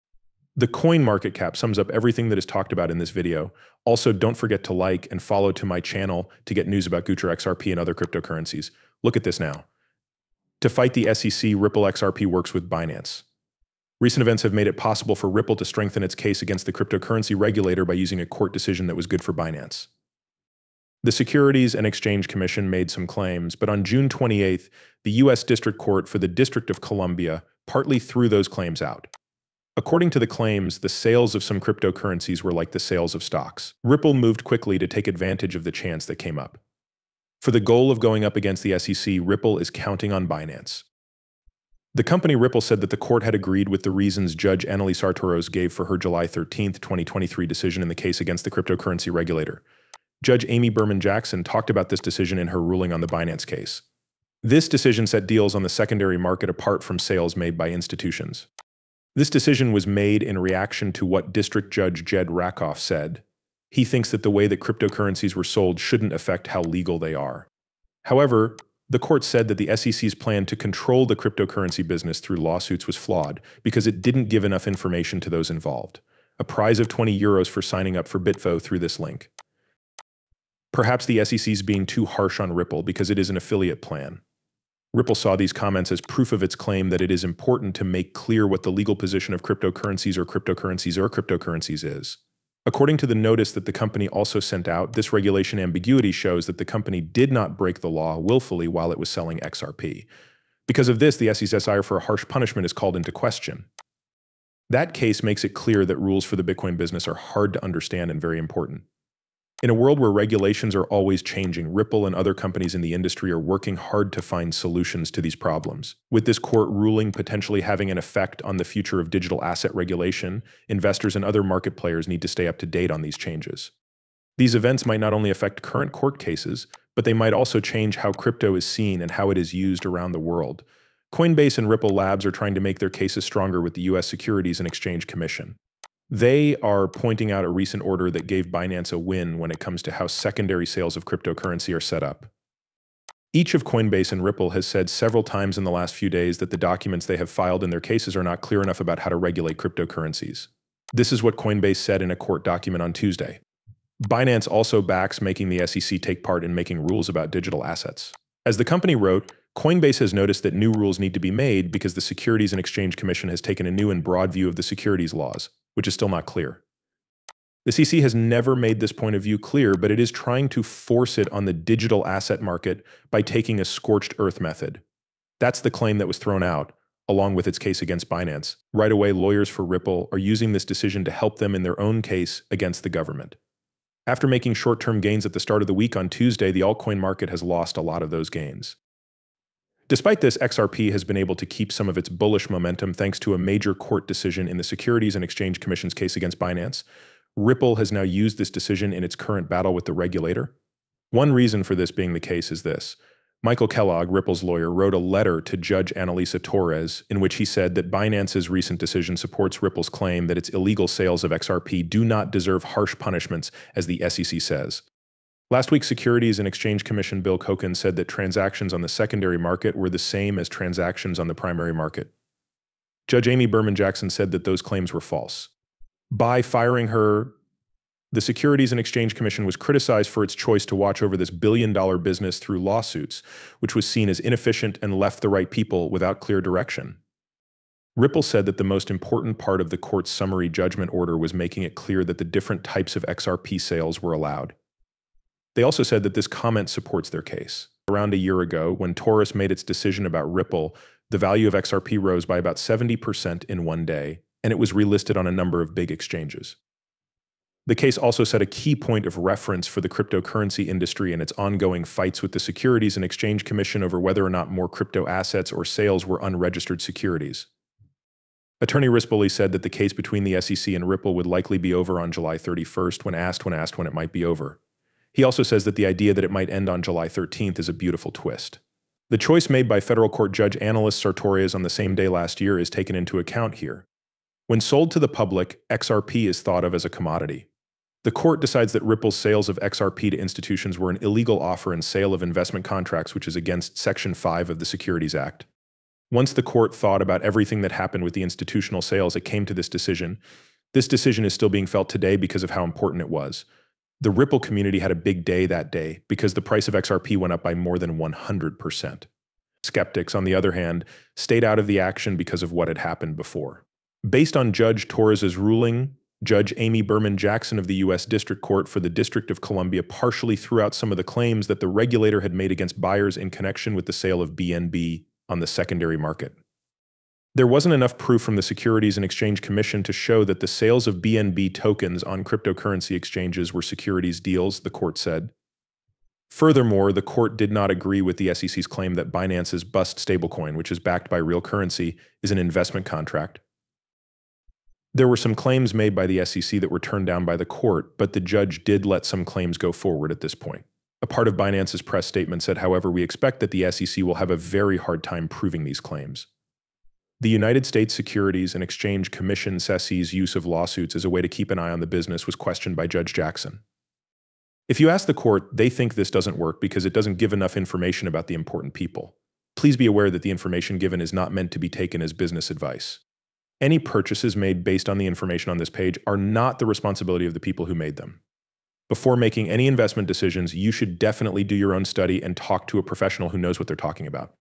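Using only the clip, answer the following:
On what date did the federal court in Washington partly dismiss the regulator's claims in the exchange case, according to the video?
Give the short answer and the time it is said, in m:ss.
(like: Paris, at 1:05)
June 28th, at 0:23.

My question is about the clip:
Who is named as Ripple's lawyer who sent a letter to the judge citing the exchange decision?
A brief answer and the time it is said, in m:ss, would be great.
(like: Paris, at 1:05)
Michael Kellogg, at 3:23.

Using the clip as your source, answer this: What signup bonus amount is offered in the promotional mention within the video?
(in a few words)
20 euros.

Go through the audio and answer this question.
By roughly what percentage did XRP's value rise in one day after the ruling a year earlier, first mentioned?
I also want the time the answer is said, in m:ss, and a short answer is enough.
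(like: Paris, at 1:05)
70%, at 4:12.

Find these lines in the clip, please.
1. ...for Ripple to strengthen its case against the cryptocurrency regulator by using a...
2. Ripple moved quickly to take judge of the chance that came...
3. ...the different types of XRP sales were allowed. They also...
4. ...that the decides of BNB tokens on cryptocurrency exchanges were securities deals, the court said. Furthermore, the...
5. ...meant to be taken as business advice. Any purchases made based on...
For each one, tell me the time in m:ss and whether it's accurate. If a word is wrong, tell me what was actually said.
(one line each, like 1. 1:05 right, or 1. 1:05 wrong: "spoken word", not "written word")
1. 0:15 right
2. 0:33 wrong: "advantage", not "judge"
3. 4:02 right
4. 5:30 wrong: "sales", not "decides"
5. 6:11 right.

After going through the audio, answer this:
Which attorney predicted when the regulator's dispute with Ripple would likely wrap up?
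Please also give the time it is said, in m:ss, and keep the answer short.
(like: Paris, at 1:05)
Rispoli, at 4:28.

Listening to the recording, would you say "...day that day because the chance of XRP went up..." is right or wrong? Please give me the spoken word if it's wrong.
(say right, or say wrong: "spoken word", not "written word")
wrong: "price", not "chance".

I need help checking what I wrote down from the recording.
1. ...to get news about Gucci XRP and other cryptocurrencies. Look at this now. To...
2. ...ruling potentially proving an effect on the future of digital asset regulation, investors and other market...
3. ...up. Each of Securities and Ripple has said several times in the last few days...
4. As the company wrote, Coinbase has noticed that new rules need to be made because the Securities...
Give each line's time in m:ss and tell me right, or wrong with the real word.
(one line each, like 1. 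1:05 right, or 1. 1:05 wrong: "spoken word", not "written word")
1. 0:06 right
2. 1:56 wrong: "having", not "proving"
3. 2:22 wrong: "Coinbase", not "Securities"
4. 2:38 right.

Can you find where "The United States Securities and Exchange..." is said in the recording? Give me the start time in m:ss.
5:57.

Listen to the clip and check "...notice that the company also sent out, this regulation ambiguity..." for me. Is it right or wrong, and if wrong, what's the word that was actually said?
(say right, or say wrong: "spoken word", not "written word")
right.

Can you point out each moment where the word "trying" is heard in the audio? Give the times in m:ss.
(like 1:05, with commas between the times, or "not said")
2:12, 2:50.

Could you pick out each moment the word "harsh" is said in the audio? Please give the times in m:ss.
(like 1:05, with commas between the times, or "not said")
1:22, 1:42, 3:32.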